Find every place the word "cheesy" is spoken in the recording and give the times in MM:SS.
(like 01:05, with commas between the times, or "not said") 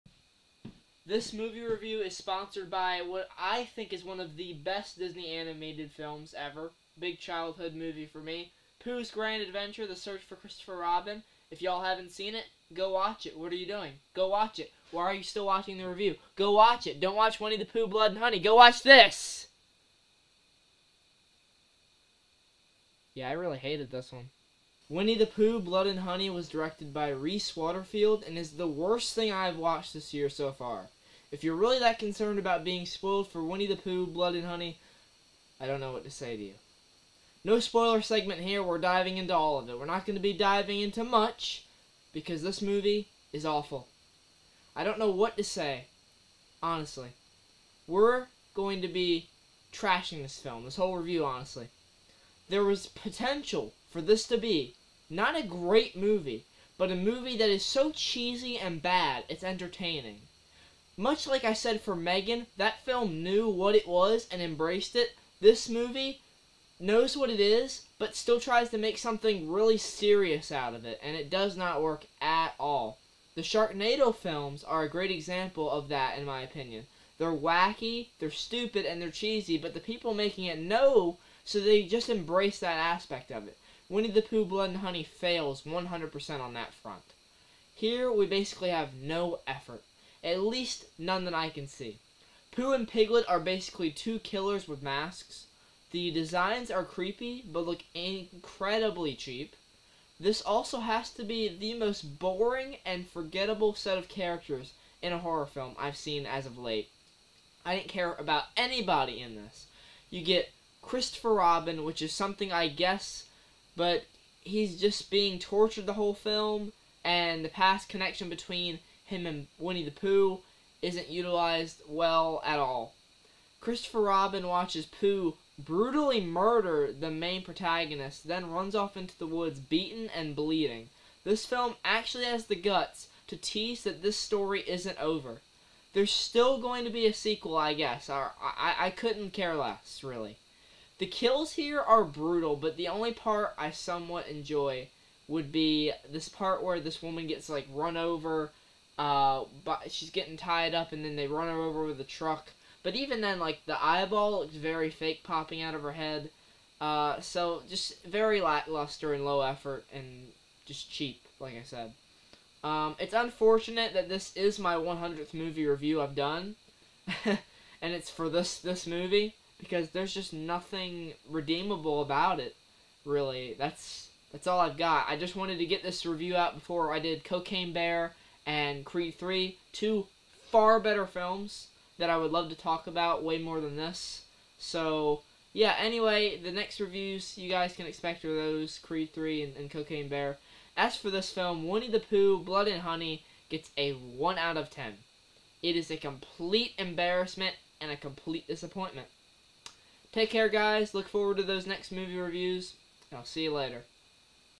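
00:57, 01:19.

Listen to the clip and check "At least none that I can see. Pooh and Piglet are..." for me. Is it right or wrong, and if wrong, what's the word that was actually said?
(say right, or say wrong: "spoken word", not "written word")
right.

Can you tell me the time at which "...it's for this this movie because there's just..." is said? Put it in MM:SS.
02:47.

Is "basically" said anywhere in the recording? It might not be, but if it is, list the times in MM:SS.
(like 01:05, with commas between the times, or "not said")
01:28, 01:33.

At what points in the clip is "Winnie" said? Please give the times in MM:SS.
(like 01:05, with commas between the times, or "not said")
00:17, 00:24, 00:33, 01:23, 01:59, 03:11.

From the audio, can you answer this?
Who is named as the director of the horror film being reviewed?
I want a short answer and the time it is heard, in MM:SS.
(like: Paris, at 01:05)
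Rhys Waterfield, at 00:27.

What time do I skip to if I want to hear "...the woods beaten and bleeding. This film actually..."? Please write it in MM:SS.
02:09.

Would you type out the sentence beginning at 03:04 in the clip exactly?
So, yeah, anyway, the next reviews you guys can expect are those Creed 3 and, and Cocaine Bear.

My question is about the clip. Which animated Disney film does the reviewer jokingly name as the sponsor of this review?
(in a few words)
Pooh's Grand Adventure.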